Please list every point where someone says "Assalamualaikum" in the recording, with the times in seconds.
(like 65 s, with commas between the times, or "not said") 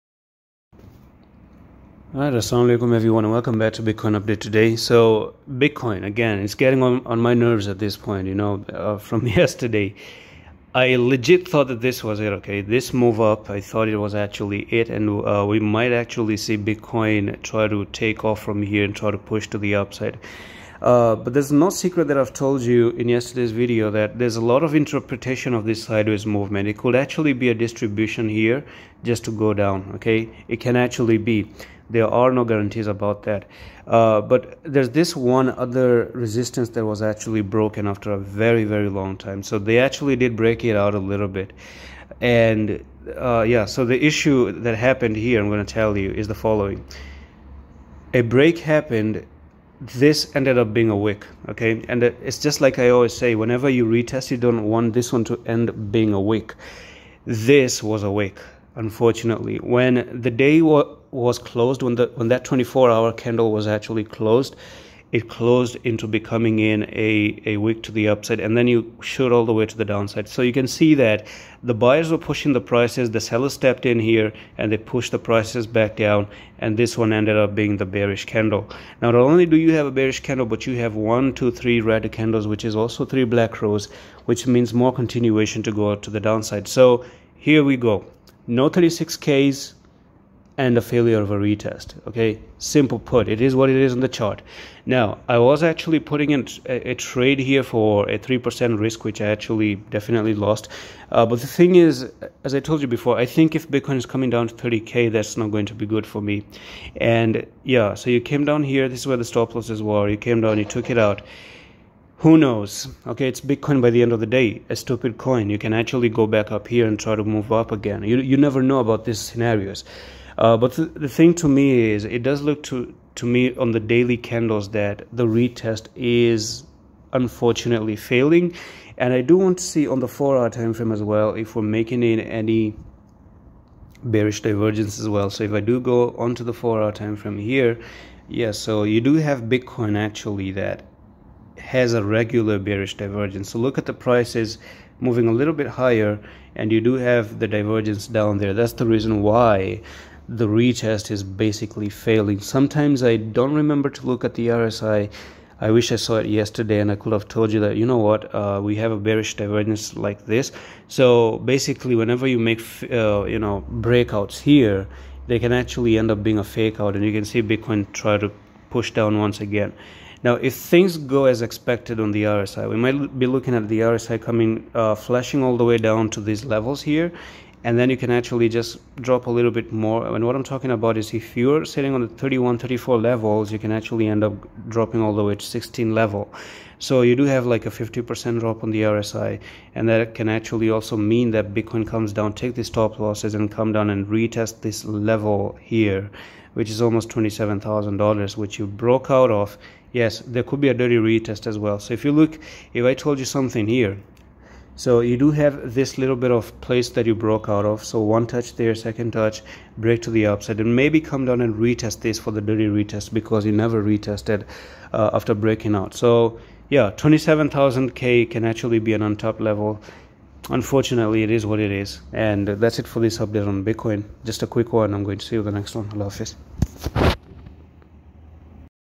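2 s.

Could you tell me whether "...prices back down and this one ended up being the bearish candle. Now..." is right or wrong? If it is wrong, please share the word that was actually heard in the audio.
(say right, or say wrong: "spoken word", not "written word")
right.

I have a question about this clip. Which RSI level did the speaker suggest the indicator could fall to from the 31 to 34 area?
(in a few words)
16.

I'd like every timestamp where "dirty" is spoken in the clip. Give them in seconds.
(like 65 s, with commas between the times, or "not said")
200 s, 212 s.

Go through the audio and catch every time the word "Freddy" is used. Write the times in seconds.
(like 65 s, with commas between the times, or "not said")
not said.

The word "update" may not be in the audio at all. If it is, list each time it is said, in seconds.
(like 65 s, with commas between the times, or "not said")
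4 s, 223 s.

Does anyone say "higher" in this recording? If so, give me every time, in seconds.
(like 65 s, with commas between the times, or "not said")
145 s.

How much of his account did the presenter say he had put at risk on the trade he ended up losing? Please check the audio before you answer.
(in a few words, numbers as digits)
3%.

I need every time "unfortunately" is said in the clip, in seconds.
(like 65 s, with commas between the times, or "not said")
58 s, 127 s, 220 s.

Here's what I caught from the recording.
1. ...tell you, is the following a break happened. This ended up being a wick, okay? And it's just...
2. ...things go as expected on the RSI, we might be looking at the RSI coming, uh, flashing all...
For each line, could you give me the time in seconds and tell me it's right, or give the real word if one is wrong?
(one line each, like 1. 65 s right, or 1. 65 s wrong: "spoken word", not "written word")
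1. 45 s right
2. 170 s right.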